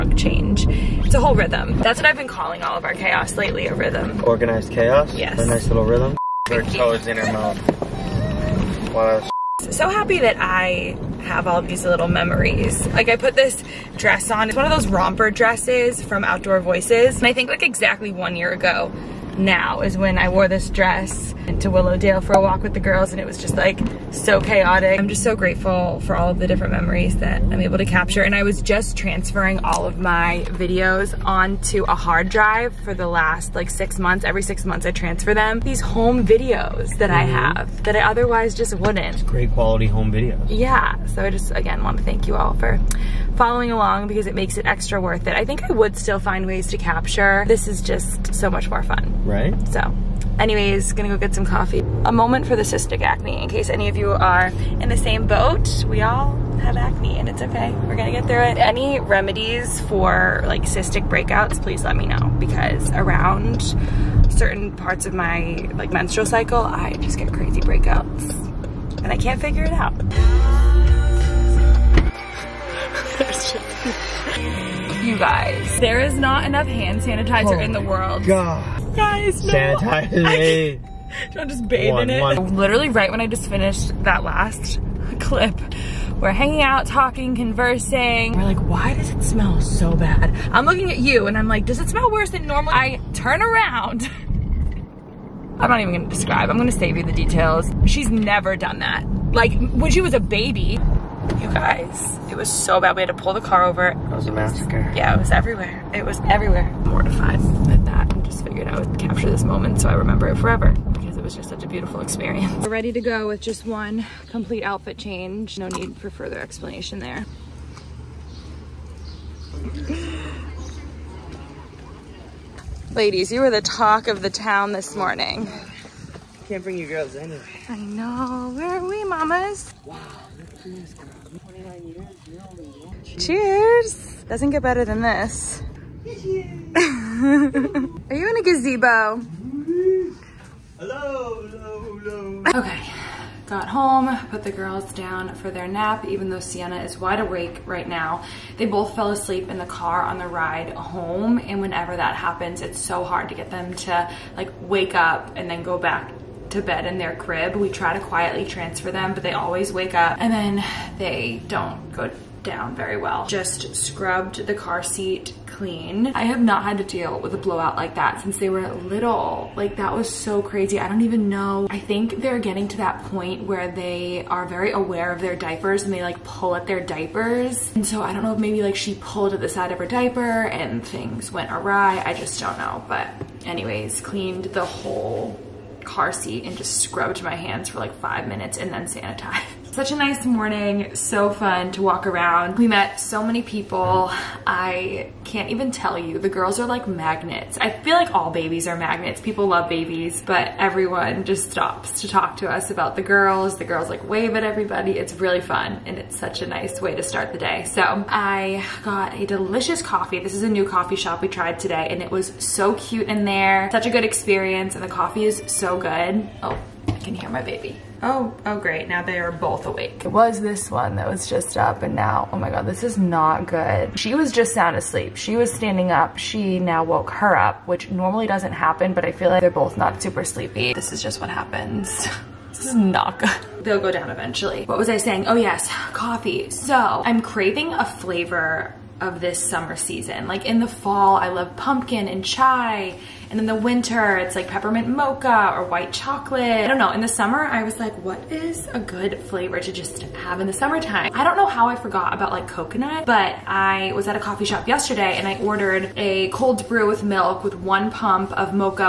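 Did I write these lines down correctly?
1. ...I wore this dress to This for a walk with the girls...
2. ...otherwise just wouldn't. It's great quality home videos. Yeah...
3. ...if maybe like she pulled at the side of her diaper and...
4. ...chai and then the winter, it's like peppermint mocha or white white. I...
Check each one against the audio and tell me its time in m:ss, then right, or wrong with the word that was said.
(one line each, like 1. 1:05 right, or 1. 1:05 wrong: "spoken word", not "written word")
1. 0:20 wrong: "Willowdale", not "This"
2. 0:37 right
3. 2:58 right
4. 4:02 wrong: "chocolate", not "white".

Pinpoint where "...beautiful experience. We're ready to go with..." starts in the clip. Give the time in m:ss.
1:51.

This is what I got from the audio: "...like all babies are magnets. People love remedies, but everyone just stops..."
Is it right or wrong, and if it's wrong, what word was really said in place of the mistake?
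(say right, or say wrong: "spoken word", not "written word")
wrong: "babies", not "remedies".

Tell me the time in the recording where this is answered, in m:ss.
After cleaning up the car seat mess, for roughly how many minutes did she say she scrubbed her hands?
3:07.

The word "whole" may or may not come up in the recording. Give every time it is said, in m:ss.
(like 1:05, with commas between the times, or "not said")
0:01, 3:04.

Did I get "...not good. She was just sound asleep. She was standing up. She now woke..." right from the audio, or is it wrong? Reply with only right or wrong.
right.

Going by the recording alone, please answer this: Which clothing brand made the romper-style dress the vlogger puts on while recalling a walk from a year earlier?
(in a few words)
Outdoor Voices.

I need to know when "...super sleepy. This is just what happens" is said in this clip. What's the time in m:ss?
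3:50.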